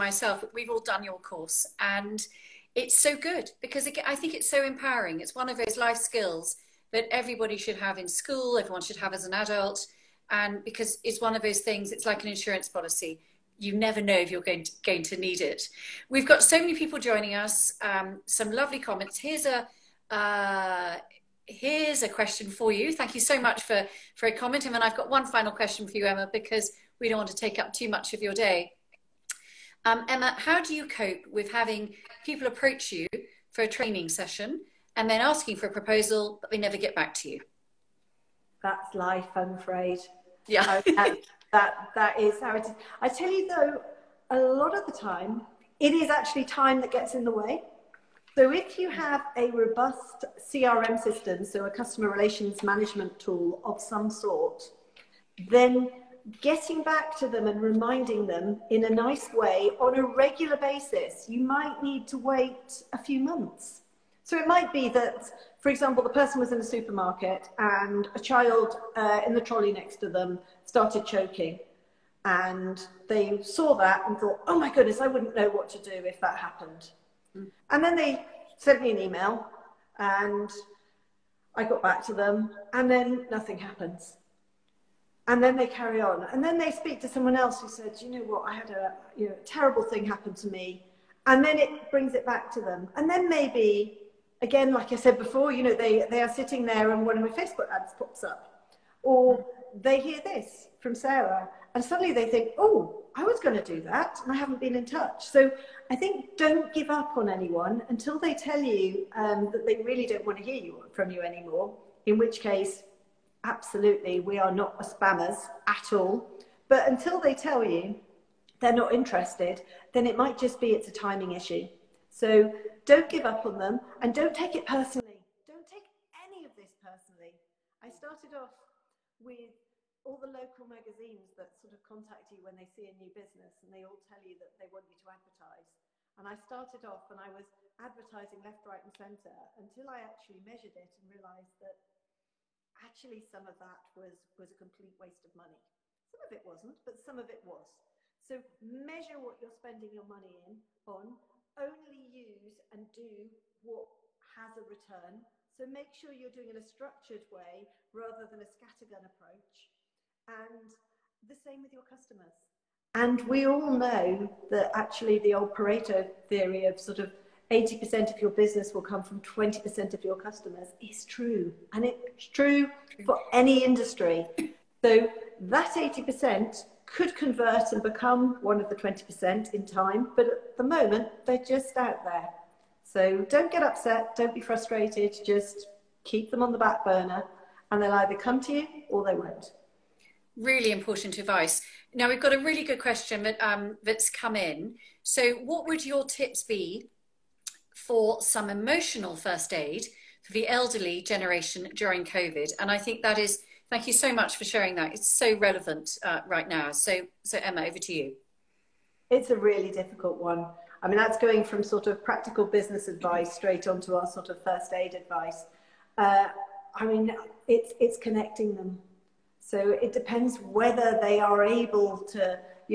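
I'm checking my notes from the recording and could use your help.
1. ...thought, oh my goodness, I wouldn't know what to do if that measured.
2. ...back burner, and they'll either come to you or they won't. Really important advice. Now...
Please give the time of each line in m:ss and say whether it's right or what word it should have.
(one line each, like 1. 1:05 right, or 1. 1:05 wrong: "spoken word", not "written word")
1. 1:14 wrong: "happened", not "measured"
2. 3:06 right.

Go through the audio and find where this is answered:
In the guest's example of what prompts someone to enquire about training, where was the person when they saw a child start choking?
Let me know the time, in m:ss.
1:06.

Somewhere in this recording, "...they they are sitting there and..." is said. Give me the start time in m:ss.
1:35.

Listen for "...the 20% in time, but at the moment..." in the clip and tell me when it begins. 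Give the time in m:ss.
2:58.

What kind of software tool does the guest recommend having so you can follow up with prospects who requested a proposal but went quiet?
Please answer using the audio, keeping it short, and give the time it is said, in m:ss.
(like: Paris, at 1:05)
CRM system, at 0:50.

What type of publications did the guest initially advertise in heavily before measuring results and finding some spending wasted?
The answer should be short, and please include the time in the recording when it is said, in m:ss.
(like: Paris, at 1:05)
local magazines, at 2:10.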